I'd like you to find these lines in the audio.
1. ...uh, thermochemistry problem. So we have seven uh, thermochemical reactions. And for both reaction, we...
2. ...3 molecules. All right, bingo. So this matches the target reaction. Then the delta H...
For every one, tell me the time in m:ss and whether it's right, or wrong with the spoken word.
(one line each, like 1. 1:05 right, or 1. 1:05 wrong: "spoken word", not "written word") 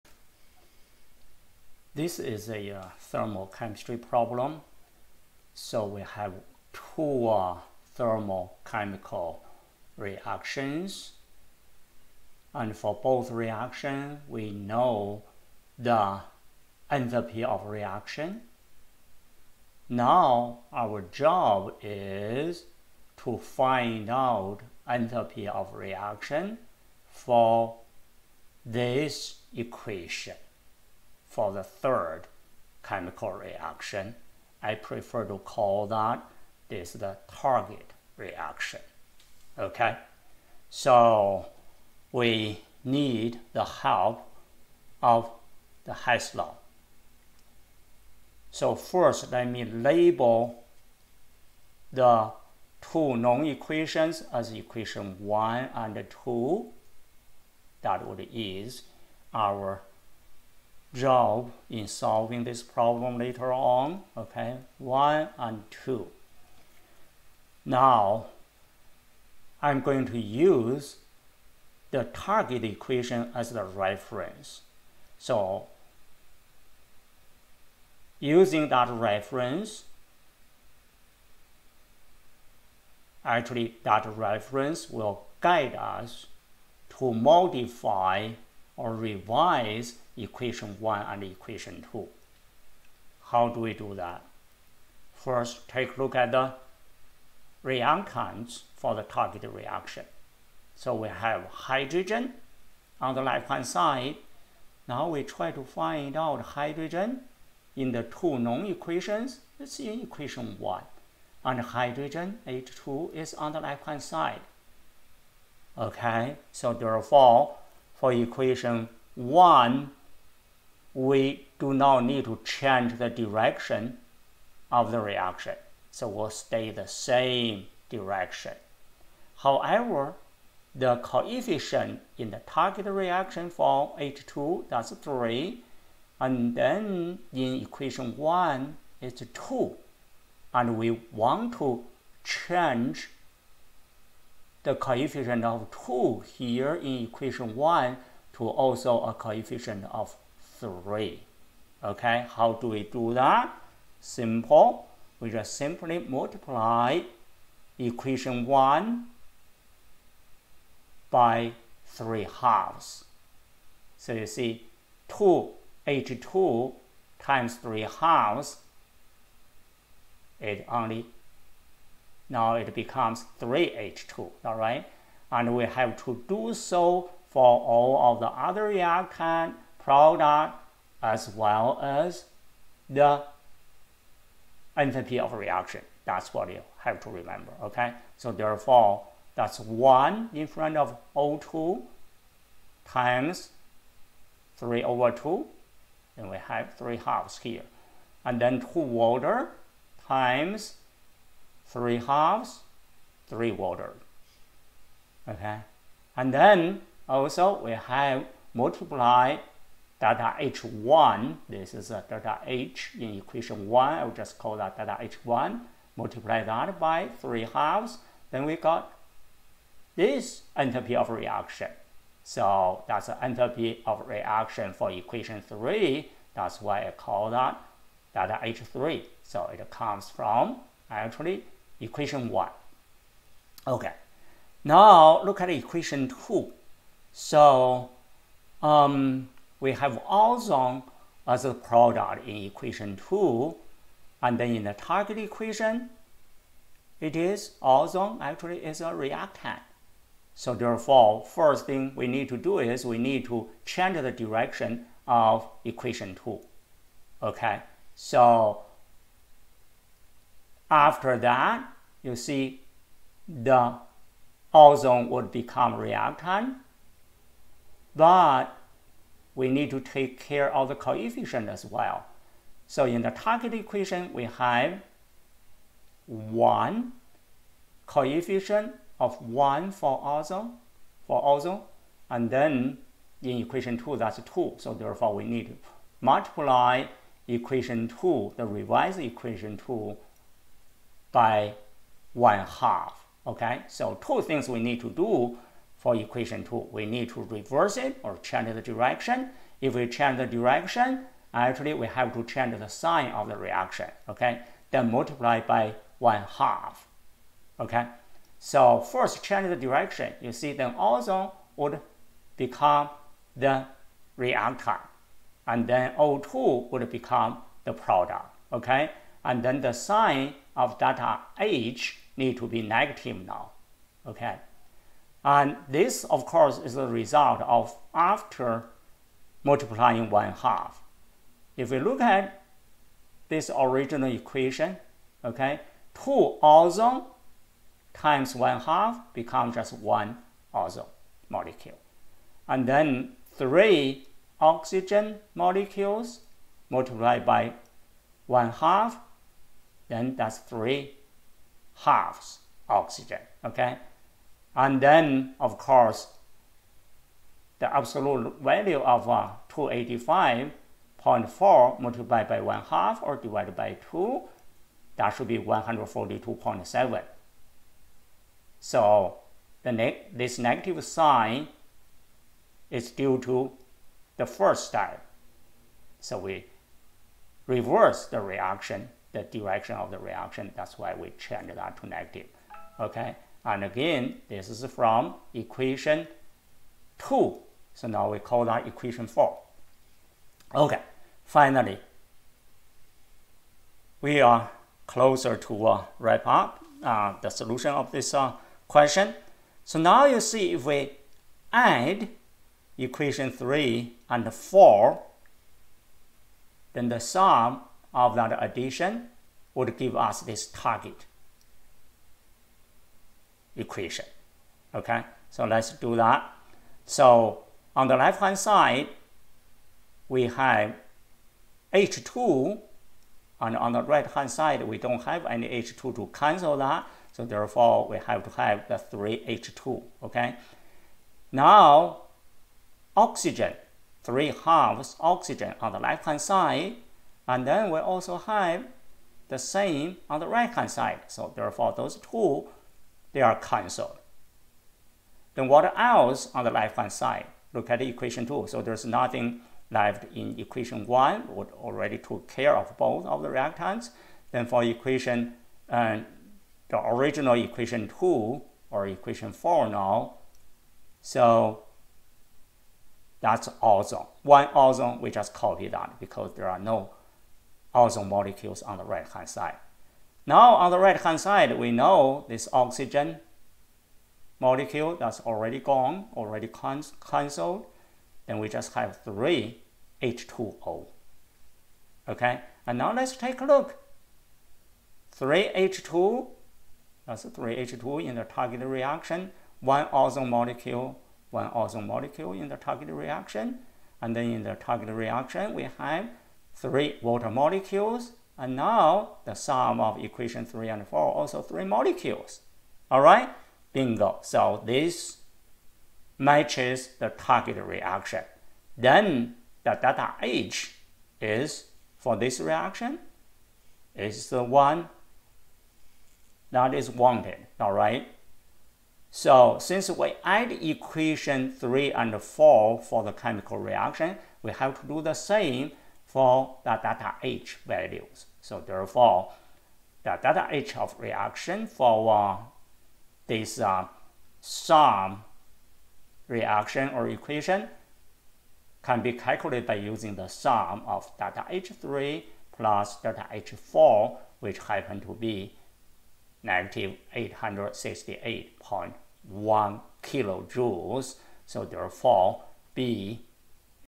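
1. 0:02 wrong: "two", not "seven"
2. 8:21 right.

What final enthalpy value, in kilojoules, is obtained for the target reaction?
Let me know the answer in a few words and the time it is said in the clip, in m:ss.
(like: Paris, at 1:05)
-868.1 kJ, at 9:06.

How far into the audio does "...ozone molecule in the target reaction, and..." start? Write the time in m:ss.
8:11.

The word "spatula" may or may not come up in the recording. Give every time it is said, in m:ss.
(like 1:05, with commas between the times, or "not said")
not said.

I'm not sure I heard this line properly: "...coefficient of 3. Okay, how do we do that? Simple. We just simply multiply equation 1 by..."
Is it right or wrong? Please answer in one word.
right.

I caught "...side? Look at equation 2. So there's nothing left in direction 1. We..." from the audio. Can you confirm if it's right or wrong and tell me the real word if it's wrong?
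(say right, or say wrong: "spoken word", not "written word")
wrong: "equation", not "direction".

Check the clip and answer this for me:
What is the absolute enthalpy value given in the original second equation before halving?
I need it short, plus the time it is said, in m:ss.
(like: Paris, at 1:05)
285.4, at 5:59.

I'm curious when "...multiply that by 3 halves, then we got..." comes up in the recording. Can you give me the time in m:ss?
3:35.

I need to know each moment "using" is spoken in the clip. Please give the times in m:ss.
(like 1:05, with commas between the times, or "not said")
1:18, 8:59.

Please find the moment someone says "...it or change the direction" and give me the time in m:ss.
4:57.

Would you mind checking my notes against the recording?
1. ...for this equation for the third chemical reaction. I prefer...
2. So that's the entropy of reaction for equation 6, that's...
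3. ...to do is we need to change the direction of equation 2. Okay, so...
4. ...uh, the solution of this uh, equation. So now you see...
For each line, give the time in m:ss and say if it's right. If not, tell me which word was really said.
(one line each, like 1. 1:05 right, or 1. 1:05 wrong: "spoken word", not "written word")
1. 0:27 right
2. 3:42 wrong: "3", not "6"
3. 4:12 right
4. 6:36 wrong: "question", not "equation".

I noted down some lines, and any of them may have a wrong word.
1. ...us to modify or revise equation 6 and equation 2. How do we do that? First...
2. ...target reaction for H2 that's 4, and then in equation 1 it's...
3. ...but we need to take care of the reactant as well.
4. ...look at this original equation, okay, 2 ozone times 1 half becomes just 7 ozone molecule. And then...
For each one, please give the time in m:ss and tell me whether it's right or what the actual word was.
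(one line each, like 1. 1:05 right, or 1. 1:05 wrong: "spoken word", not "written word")
1. 1:25 wrong: "1", not "6"
2. 2:12 wrong: "3", not "4"
3. 4:27 wrong: "coefficient", not "reactant"
4. 5:31 wrong: "1", not "7".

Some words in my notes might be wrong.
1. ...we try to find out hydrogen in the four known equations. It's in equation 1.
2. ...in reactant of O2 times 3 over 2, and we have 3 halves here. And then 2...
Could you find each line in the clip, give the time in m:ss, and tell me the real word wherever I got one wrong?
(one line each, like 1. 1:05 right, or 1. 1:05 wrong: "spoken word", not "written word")
1. 1:45 wrong: "two", not "four"
2. 3:10 wrong: "front", not "reactant".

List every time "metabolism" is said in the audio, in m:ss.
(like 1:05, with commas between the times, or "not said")
not said.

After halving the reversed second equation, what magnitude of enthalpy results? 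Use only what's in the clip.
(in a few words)
142.7.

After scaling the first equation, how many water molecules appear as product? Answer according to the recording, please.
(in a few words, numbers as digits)
3.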